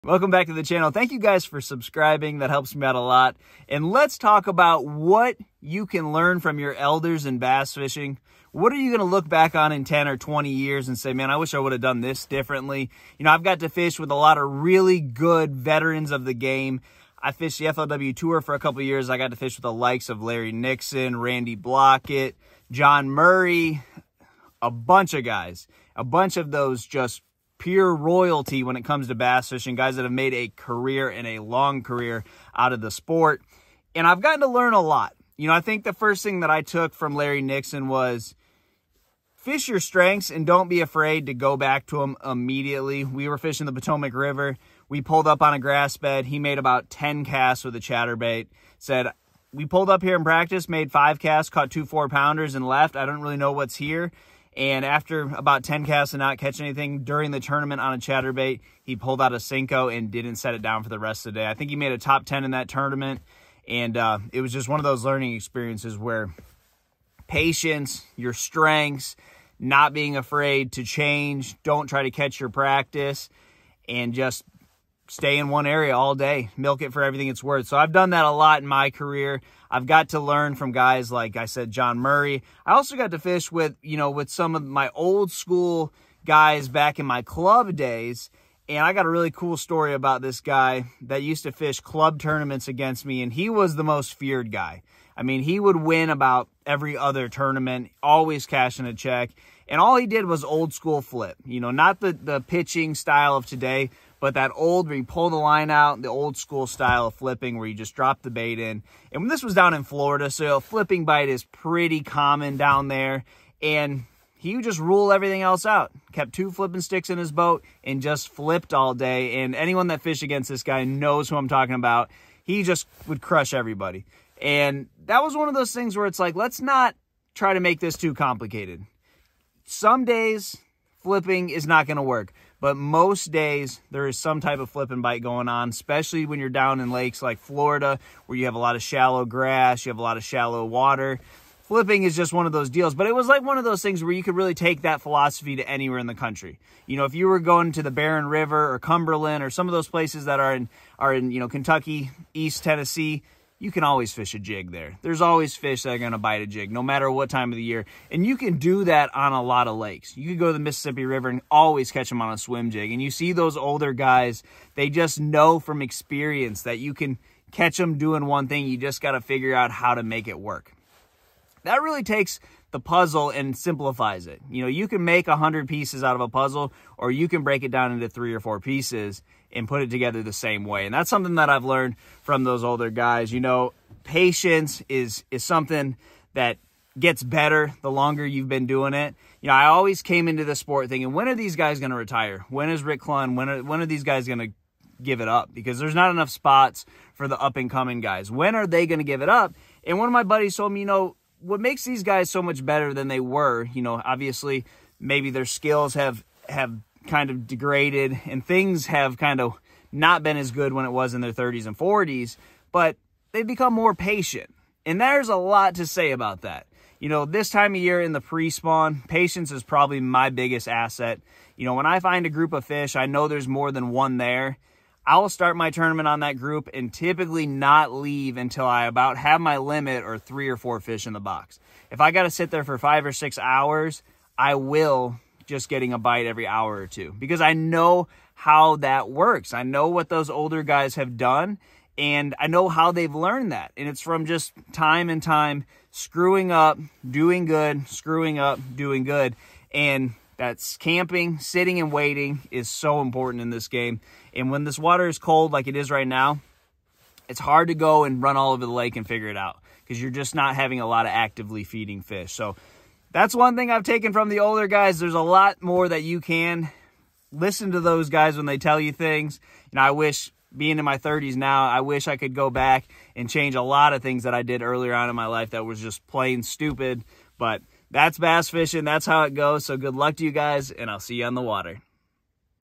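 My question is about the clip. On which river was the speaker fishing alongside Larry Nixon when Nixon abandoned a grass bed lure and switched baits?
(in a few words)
Potomac River.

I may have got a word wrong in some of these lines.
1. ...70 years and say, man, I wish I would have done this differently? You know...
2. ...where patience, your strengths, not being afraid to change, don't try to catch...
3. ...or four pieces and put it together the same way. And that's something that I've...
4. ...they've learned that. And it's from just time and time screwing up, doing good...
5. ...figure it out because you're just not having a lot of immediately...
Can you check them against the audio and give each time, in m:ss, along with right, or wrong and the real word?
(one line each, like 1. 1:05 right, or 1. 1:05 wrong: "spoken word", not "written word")
1. 0:10 wrong: "20", not "70"
2. 1:05 right
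3. 2:58 right
4. 4:02 right
5. 4:19 wrong: "actively", not "immediately".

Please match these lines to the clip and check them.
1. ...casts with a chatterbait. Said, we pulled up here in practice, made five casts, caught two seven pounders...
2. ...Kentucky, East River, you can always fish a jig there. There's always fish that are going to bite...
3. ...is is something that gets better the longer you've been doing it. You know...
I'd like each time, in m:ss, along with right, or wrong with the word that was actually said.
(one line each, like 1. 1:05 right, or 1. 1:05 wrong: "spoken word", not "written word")
1. 0:47 wrong: "four", not "seven"
2. 2:31 wrong: "Tennessee", not "River"
3. 3:04 right.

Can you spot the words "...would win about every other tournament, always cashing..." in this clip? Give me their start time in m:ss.
1:35.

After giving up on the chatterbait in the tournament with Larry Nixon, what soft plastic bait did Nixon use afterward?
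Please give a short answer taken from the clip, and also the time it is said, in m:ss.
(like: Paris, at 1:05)
Senko, at 0:59.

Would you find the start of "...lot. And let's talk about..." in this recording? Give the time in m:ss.
0:02.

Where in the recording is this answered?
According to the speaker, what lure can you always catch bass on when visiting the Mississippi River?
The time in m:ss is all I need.
2:42.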